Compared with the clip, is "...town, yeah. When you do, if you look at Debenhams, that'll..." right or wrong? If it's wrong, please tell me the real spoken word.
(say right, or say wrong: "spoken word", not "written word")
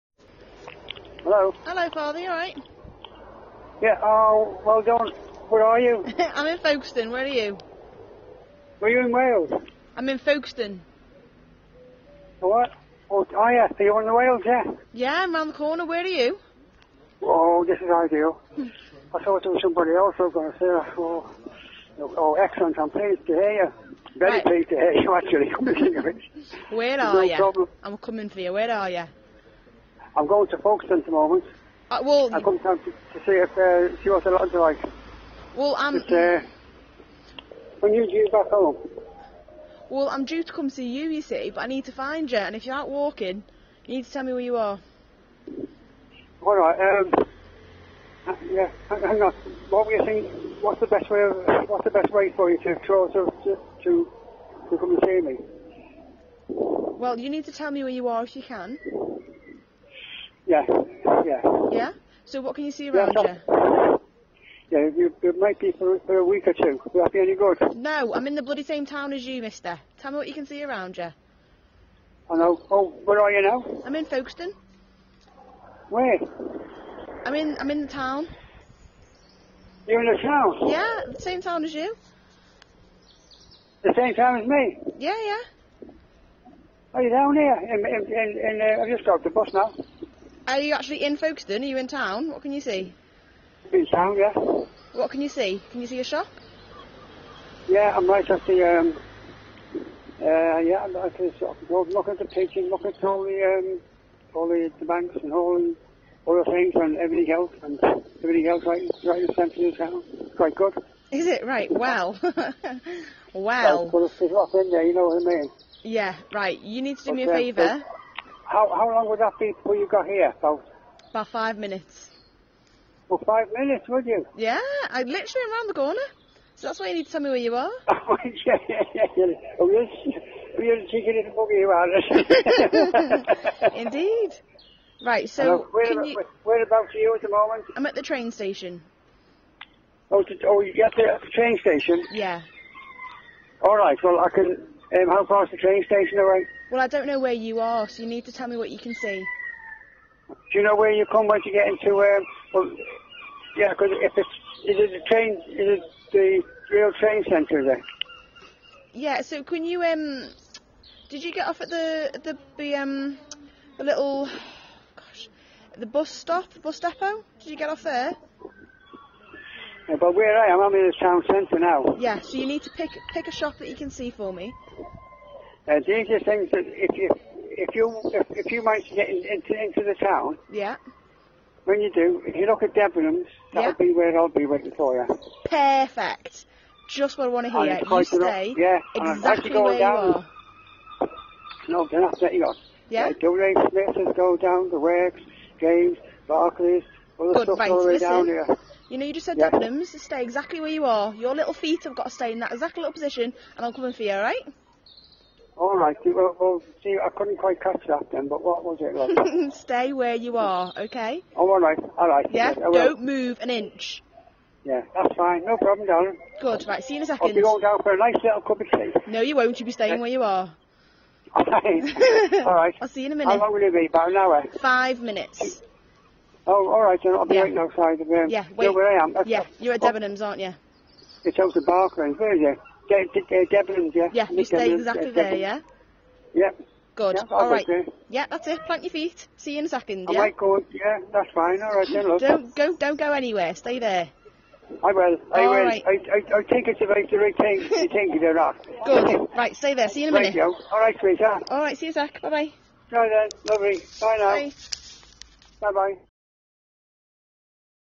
right.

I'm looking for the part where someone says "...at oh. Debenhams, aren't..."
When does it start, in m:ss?
3:49.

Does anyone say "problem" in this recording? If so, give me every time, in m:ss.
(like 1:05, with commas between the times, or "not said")
0:27, 3:35.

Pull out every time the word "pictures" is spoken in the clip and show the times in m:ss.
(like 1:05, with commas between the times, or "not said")
1:42.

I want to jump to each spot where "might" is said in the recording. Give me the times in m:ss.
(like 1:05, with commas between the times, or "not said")
1:05, 4:00.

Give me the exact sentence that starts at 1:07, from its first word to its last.
No, I'm in the bloody same town as you, mister.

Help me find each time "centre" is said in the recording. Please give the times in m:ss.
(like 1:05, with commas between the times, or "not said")
1:49, 2:37, 2:51.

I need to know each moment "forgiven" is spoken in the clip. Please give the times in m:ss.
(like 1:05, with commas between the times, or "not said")
not said.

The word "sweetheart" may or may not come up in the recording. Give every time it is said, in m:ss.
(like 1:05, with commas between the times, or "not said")
4:10.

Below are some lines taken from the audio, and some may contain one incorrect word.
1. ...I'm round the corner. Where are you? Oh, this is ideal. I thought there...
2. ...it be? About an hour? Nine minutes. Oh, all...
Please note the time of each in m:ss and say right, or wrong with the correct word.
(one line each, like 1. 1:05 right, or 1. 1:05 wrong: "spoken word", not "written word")
1. 0:15 right
2. 3:43 wrong: "Five", not "Nine".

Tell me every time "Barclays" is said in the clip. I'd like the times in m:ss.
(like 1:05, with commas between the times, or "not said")
3:16, 3:51.